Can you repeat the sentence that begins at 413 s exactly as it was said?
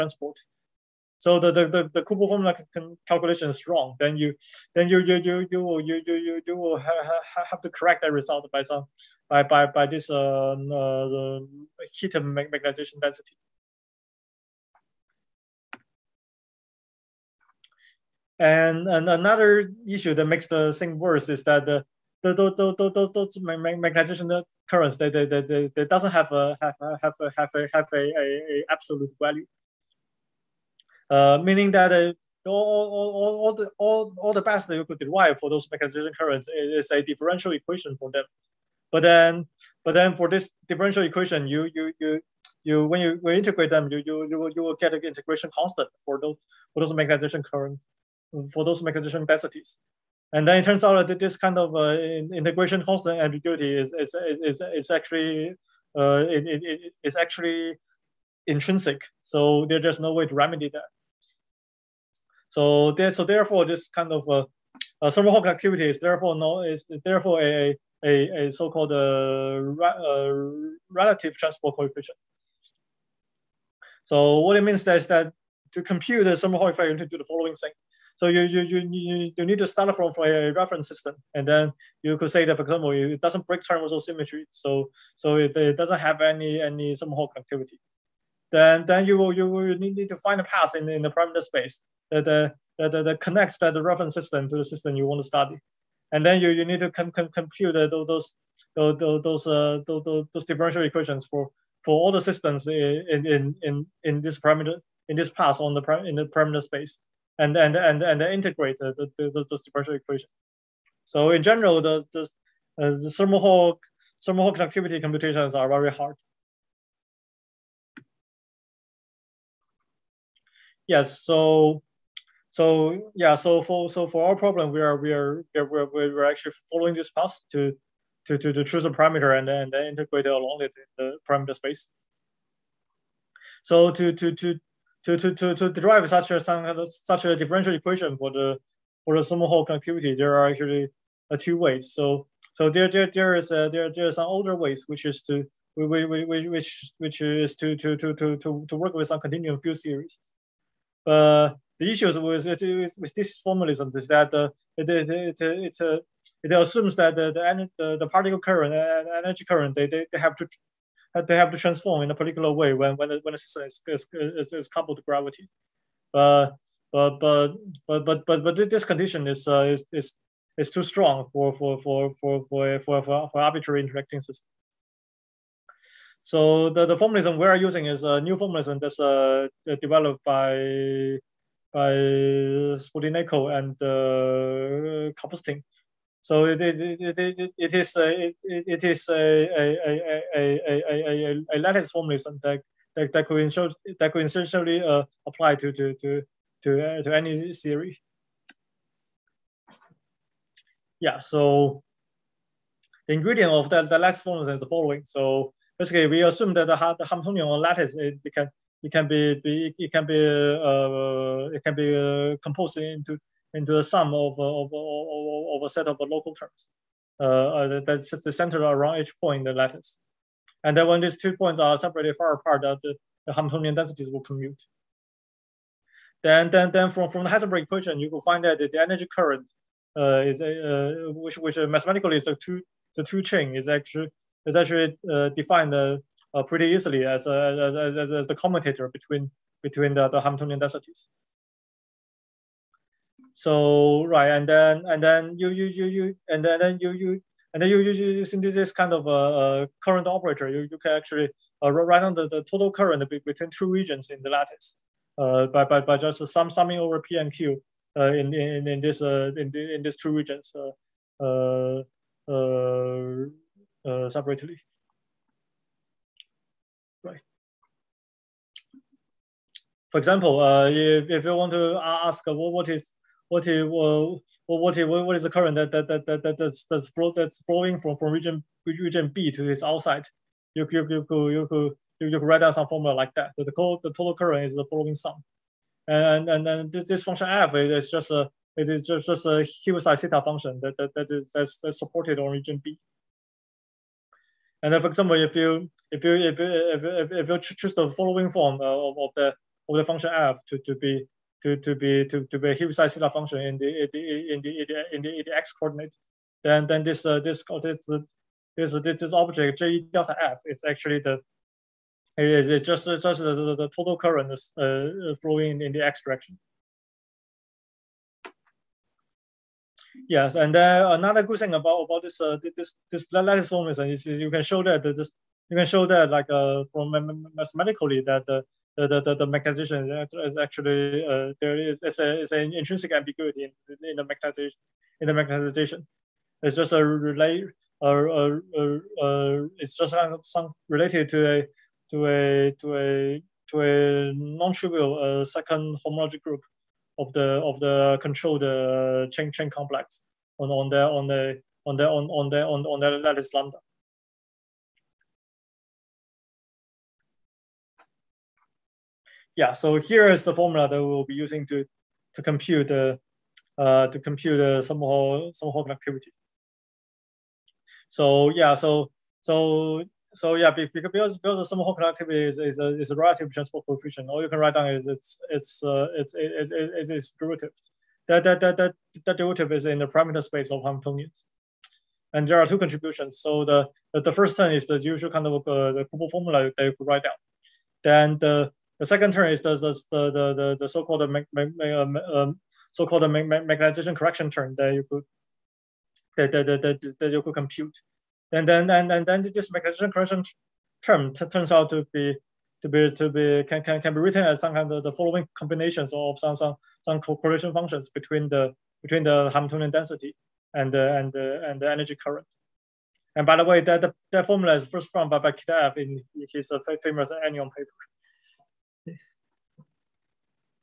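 And by the way, that that formula is first found by, by Kitaev in his uh, famous anyon paper.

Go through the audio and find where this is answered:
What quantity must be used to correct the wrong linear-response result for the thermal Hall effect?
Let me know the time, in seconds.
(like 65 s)
11 s.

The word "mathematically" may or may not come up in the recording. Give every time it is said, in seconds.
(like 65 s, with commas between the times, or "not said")
231 s, 327 s.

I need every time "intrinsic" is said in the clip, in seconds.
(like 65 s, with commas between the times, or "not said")
58 s, 332 s.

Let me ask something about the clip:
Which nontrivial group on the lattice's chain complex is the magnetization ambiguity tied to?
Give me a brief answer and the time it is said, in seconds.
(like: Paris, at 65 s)
Second homology group, at 345 s.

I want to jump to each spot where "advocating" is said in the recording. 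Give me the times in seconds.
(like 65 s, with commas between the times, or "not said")
not said.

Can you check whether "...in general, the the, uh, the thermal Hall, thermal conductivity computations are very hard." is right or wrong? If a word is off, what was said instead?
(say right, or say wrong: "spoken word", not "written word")
right.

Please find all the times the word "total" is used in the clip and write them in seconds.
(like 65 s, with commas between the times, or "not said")
252 s, 283 s, 313 s.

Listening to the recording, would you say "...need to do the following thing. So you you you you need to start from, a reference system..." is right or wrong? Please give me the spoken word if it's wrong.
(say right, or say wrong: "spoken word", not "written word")
right.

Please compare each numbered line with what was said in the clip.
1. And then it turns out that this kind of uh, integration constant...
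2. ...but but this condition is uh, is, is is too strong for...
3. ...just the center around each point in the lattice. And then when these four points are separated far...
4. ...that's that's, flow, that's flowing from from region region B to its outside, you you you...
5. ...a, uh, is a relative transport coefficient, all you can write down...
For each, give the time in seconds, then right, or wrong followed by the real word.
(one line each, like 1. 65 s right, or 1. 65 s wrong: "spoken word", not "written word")
1. 50 s right
2. 168 s right
3. 218 s wrong: "two", not "four"
4. 276 s right
5. 372 s right.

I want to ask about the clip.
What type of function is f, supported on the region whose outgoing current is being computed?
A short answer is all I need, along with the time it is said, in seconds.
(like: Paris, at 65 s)
Heaviside theta function, at 289 s.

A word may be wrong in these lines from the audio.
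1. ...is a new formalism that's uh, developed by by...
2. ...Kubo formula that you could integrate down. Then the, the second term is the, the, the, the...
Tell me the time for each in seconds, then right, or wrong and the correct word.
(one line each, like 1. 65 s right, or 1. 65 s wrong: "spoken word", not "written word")
1. 177 s right
2. 385 s wrong: "write", not "integrate".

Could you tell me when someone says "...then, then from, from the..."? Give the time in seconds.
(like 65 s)
226 s.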